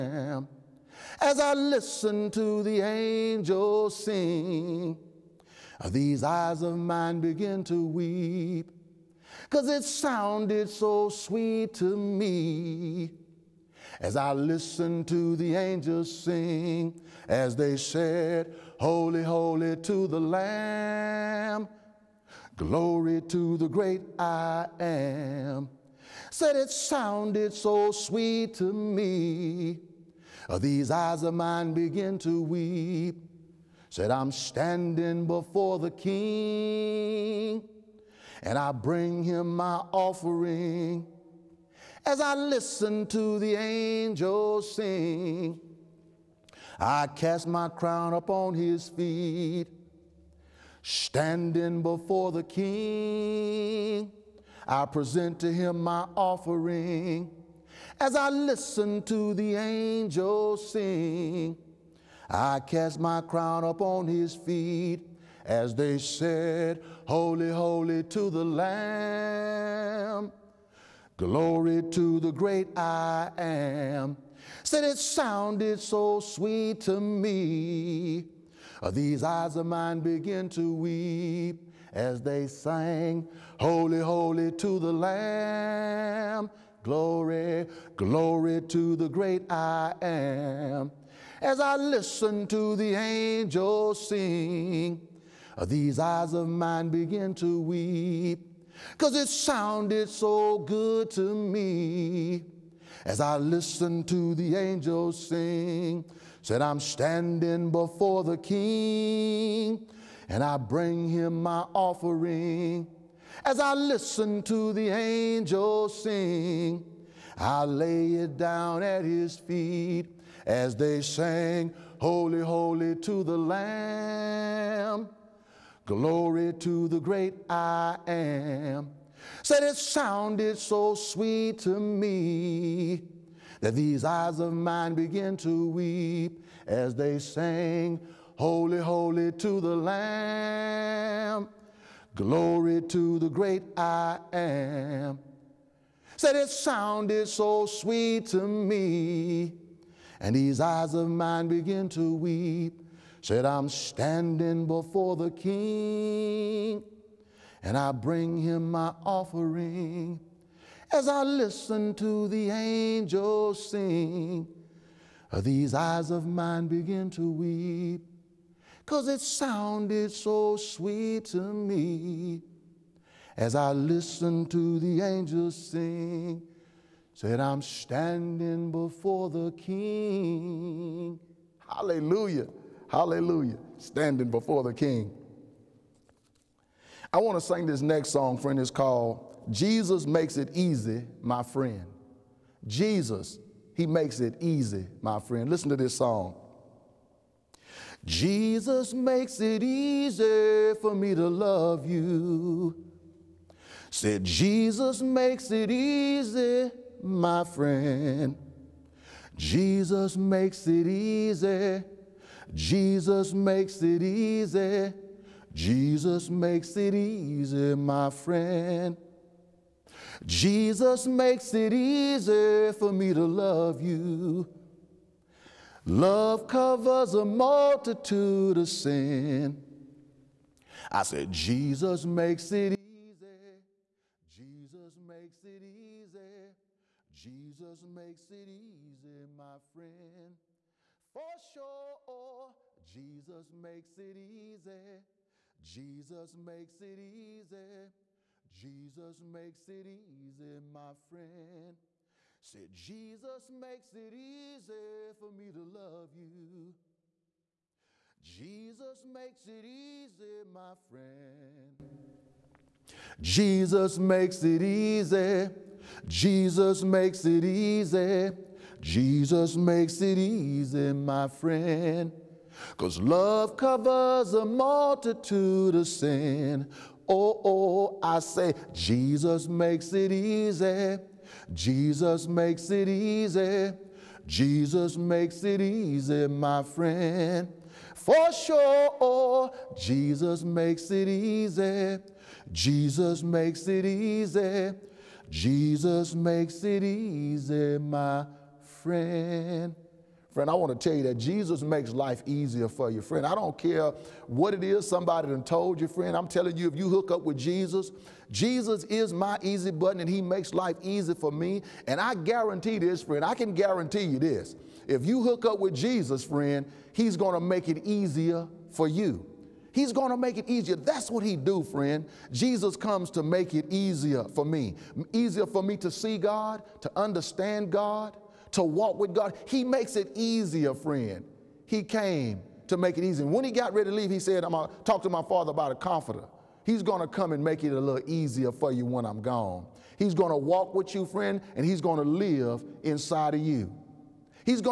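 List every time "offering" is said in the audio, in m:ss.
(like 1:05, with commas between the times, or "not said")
0:39, 0:56, 1:51, 2:39.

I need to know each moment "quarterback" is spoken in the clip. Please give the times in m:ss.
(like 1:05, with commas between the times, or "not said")
not said.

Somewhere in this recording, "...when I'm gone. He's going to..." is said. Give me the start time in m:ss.
5:38.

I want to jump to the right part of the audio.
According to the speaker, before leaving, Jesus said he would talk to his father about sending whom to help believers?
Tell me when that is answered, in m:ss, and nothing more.
5:35.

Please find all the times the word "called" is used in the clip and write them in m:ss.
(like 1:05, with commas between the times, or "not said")
3:08.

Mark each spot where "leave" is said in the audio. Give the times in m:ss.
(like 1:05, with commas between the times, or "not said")
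5:33.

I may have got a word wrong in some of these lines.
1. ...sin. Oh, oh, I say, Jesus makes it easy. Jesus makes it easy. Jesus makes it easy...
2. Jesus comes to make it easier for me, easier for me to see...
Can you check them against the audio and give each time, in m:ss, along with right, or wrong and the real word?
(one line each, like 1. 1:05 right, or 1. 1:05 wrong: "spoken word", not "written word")
1. 4:35 right
2. 5:22 right.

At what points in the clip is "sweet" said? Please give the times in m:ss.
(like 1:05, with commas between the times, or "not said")
0:11, 0:27, 1:16, 2:10, 2:27, 2:50.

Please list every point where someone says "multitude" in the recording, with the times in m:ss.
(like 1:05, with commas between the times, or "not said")
3:47, 4:34.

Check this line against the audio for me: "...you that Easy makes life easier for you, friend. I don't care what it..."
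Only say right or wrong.
wrong.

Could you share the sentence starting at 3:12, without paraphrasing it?
Jesus, He makes it easy, my friend.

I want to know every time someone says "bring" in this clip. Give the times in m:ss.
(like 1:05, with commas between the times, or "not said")
0:38, 1:50, 2:37.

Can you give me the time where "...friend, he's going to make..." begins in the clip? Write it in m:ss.
5:16.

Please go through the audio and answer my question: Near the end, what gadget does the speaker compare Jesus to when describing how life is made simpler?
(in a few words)
easy button.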